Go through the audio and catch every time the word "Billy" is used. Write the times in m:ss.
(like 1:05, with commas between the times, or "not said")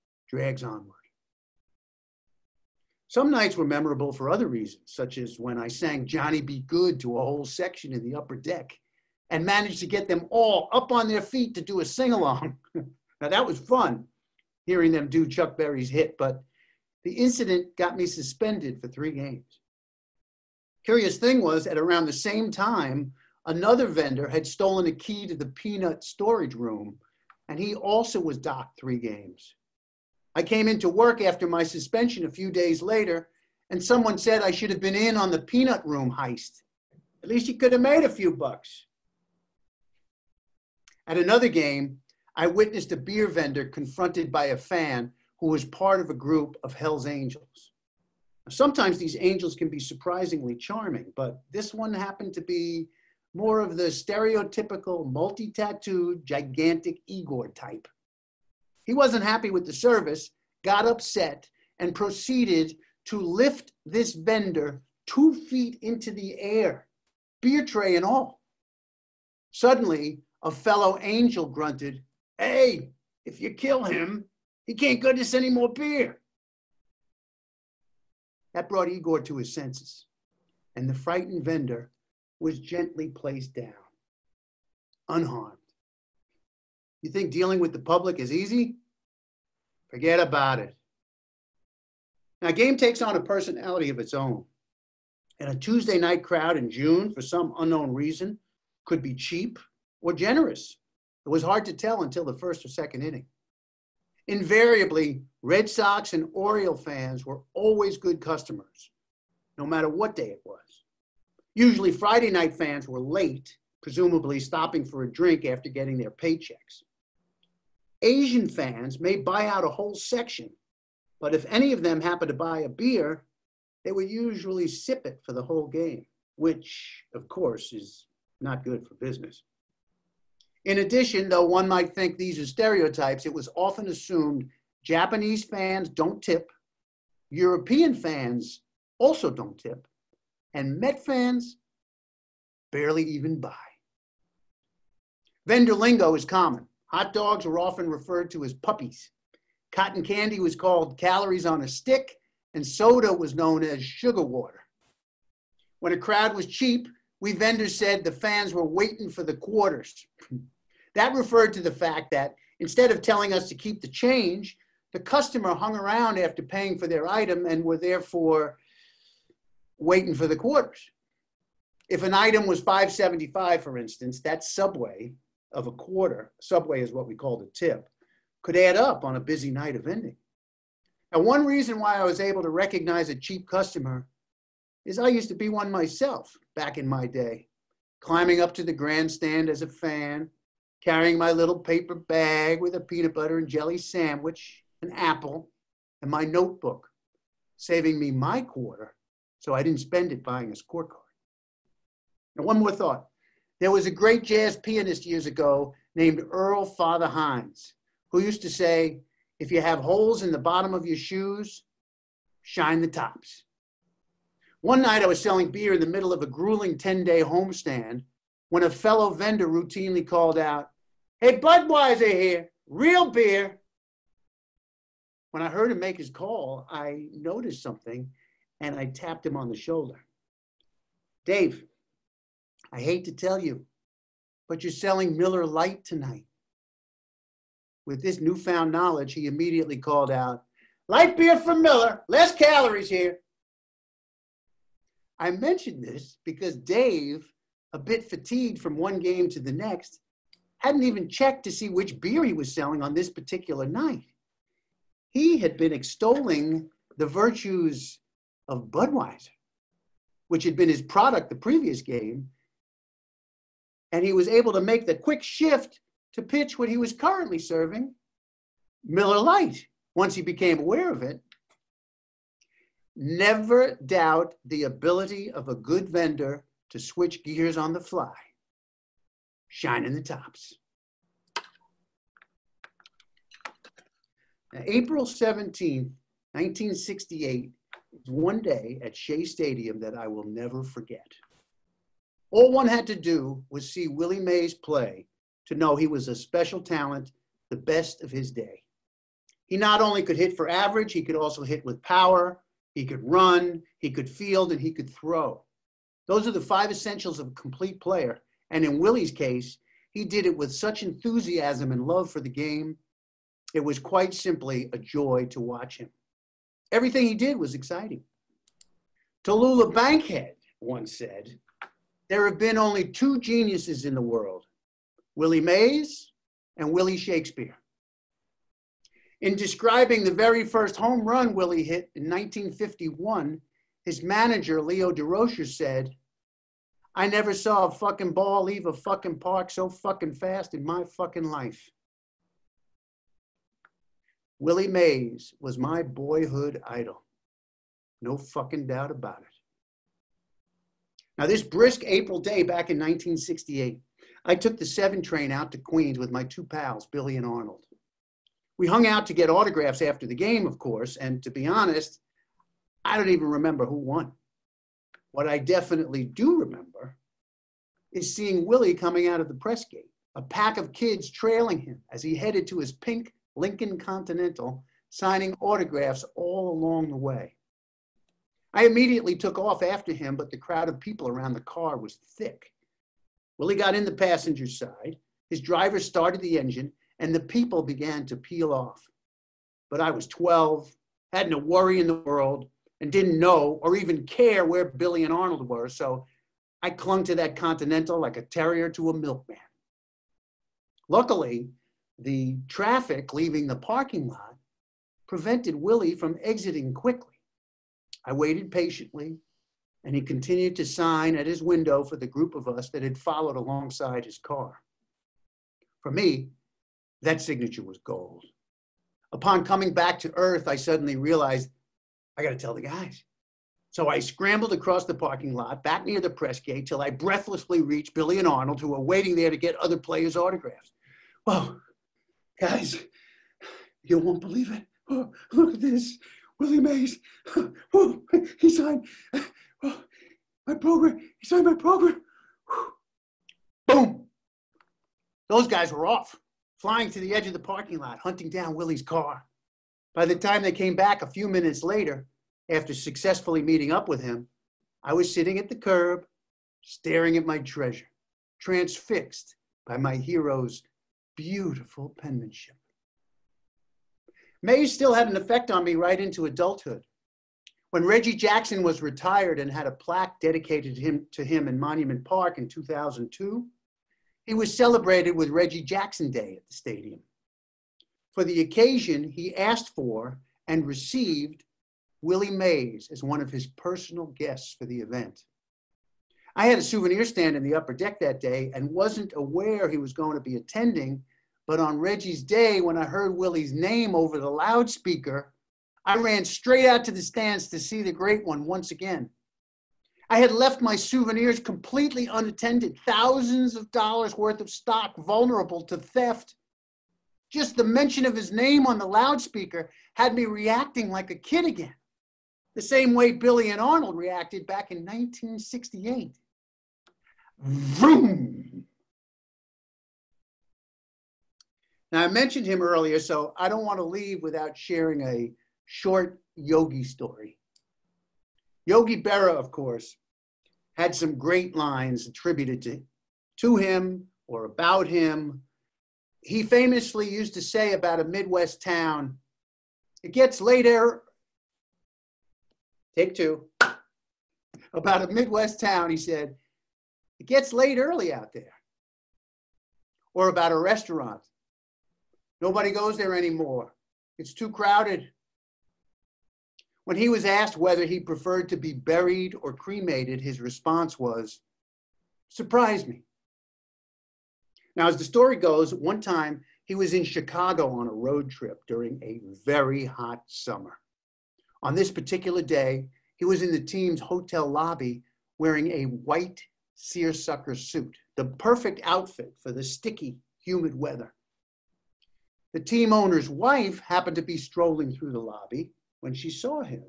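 5:56, 6:34, 7:07, 8:33.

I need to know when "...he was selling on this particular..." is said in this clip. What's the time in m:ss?
4:12.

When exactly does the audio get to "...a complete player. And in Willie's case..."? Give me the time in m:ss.
5:07.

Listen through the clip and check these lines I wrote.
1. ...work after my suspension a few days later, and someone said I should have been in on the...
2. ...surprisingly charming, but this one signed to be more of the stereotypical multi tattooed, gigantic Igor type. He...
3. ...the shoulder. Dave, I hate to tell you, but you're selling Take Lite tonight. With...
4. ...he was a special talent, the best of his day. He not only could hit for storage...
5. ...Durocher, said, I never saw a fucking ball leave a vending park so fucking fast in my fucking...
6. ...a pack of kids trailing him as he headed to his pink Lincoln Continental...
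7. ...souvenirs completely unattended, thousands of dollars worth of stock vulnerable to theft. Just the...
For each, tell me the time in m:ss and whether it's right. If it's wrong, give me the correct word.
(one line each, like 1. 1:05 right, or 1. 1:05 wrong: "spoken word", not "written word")
1. 0:30 right
2. 0:49 wrong: "happened", not "signed"
3. 3:49 wrong: "Miller", not "Take"
4. 4:55 wrong: "average", not "storage"
5. 5:34 wrong: "fucking", not "vending"
6. 6:10 right
7. 8:20 right.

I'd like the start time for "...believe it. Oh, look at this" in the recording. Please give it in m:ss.
7:14.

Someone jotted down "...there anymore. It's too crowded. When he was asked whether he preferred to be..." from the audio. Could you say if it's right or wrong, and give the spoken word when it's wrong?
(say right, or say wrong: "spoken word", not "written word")
right.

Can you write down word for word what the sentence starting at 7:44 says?
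May still had an effect on me right into adulthood.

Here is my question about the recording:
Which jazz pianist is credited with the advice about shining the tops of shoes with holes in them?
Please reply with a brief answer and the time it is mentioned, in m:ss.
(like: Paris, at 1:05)
Earl Fatha Hines, at 3:26.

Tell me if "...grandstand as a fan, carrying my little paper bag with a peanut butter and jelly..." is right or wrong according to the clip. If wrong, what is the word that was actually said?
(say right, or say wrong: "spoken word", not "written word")
right.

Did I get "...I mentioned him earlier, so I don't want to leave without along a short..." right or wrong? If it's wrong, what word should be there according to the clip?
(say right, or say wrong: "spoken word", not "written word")
wrong: "sharing", not "along".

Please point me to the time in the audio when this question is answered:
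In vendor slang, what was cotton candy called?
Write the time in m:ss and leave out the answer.
2:30.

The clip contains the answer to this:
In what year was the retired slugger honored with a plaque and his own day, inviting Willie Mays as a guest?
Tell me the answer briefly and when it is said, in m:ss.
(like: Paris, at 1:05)
2002, at 7:52.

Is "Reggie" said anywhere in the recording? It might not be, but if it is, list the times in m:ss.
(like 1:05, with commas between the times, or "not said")
7:47, 7:55, 8:11.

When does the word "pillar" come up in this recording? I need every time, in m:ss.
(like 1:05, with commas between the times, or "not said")
not said.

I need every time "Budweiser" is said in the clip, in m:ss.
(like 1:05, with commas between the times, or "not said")
3:41, 4:18.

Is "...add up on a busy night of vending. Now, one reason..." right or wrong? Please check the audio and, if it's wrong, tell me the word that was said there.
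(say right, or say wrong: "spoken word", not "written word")
right.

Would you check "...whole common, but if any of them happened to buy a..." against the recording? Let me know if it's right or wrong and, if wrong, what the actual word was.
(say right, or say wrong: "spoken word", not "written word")
wrong: "section", not "common".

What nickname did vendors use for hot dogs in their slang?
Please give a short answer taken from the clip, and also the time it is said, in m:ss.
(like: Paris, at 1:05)
puppies, at 2:28.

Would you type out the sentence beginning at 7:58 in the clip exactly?
For the occasion, he asked for and received Willie Mays as one of his personal guests for the event.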